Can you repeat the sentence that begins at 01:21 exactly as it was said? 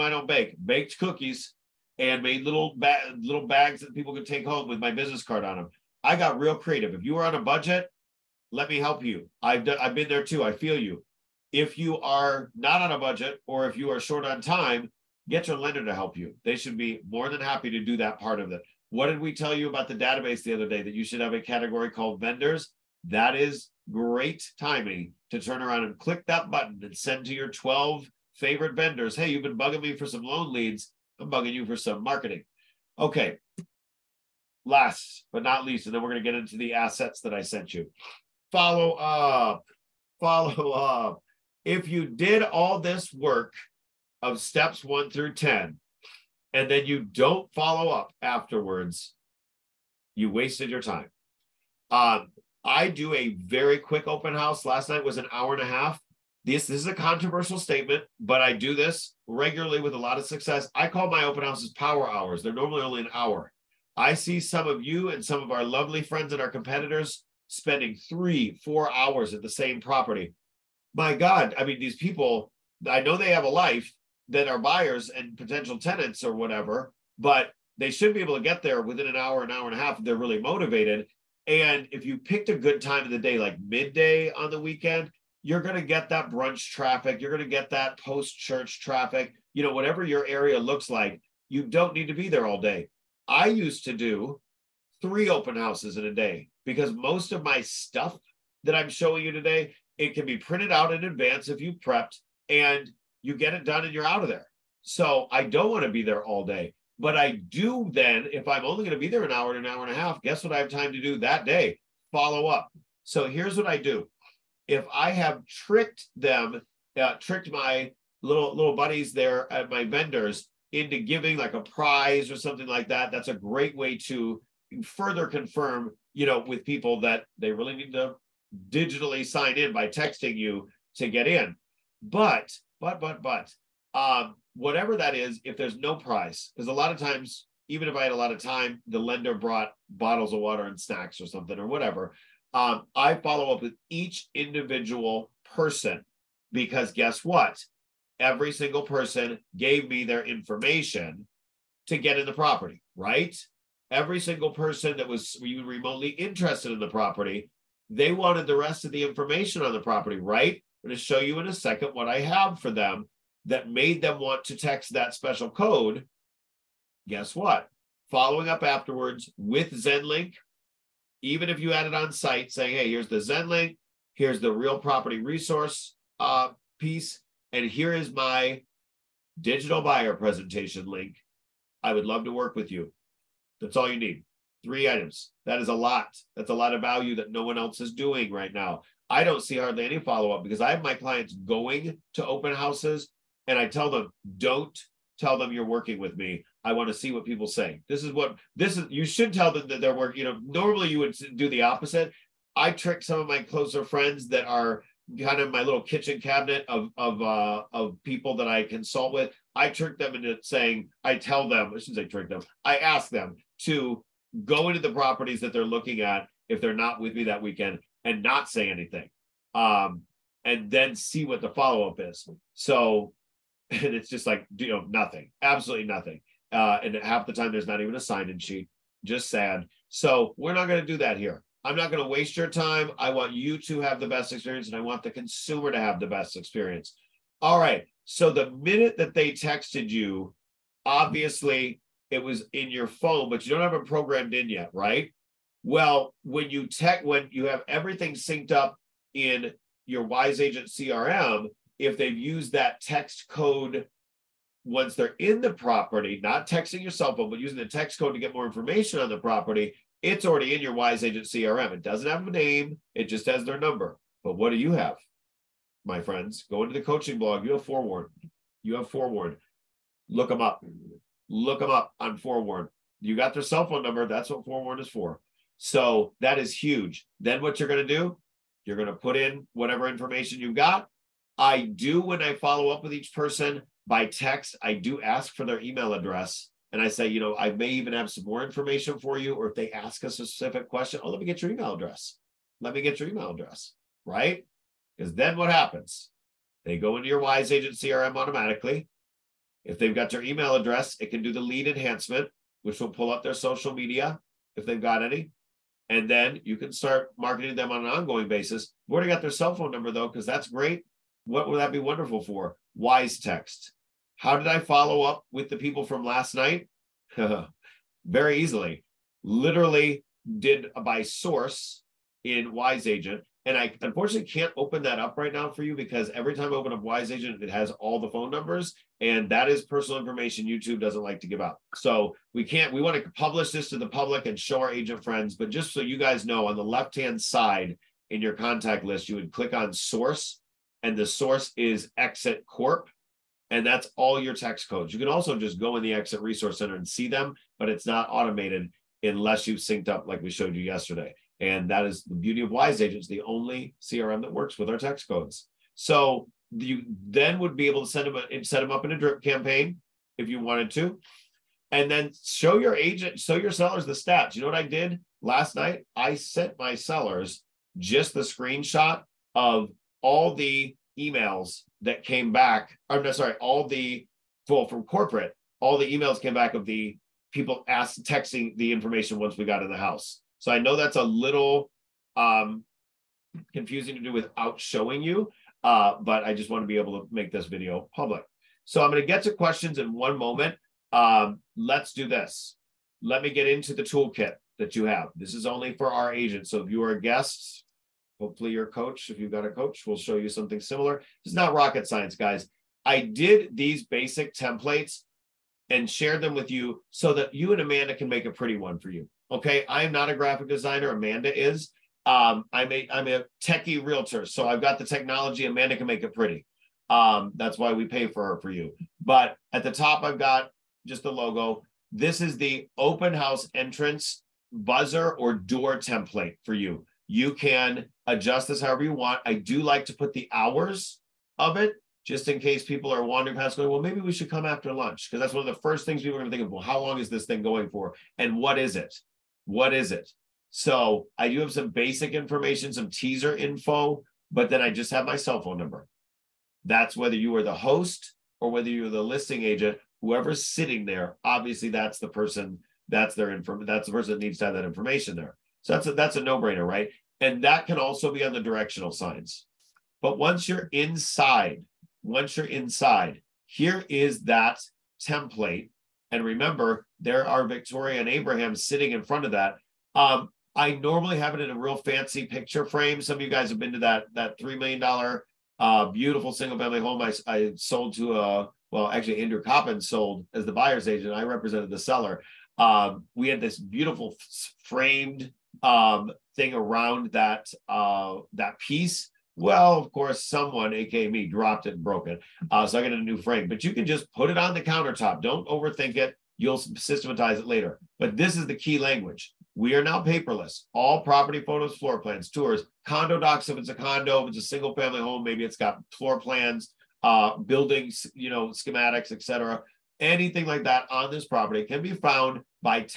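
And if you picked a good time of the day, like midday on the weekend, you're going to get that brunch traffic.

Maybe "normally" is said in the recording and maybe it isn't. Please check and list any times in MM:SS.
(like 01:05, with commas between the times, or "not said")
01:02, 03:20, 07:50.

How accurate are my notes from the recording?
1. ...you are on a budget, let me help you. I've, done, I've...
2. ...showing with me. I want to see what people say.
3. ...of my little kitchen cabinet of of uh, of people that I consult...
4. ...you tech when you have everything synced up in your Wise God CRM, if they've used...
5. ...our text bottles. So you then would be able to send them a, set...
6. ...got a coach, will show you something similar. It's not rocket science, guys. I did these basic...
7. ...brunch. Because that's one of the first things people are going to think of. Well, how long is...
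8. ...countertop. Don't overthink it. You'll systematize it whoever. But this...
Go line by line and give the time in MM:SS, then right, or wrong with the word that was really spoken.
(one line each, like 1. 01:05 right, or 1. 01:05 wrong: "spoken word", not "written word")
1. 00:07 right
2. 03:15 wrong: "working", not "showing"
3. 03:25 right
4. 04:06 wrong: "Agent", not "God"
5. 05:54 wrong: "codes", not "bottles"
6. 06:39 right
7. 07:14 wrong: "lunch", not "brunch"
8. 08:14 wrong: "later", not "whoever".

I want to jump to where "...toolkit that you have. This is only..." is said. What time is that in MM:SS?
06:33.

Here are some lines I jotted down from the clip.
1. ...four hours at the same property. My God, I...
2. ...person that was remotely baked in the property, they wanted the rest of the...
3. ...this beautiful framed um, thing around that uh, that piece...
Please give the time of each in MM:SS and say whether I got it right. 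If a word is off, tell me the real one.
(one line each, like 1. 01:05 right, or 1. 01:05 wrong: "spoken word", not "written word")
1. 01:08 right
2. 02:34 wrong: "interested", not "baked"
3. 08:03 right.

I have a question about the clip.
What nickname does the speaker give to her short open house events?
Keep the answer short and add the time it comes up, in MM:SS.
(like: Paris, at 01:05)
power hours, at 01:01.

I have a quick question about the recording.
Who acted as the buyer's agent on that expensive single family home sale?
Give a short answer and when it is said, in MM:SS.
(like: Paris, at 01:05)
Andrew Coppin, at 07:59.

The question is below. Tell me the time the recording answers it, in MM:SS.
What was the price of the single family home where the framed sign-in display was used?
07:54.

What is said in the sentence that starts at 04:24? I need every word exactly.
But what do you have, my friends?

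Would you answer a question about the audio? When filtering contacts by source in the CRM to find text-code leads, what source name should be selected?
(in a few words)
Exit Corp.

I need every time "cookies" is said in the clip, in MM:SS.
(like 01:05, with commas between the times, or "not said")
00:00.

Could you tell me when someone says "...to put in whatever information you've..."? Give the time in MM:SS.
04:38.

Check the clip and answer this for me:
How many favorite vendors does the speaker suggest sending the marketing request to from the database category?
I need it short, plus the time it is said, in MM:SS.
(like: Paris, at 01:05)
12, at 00:27.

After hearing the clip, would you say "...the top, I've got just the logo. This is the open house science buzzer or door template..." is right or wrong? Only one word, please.
wrong.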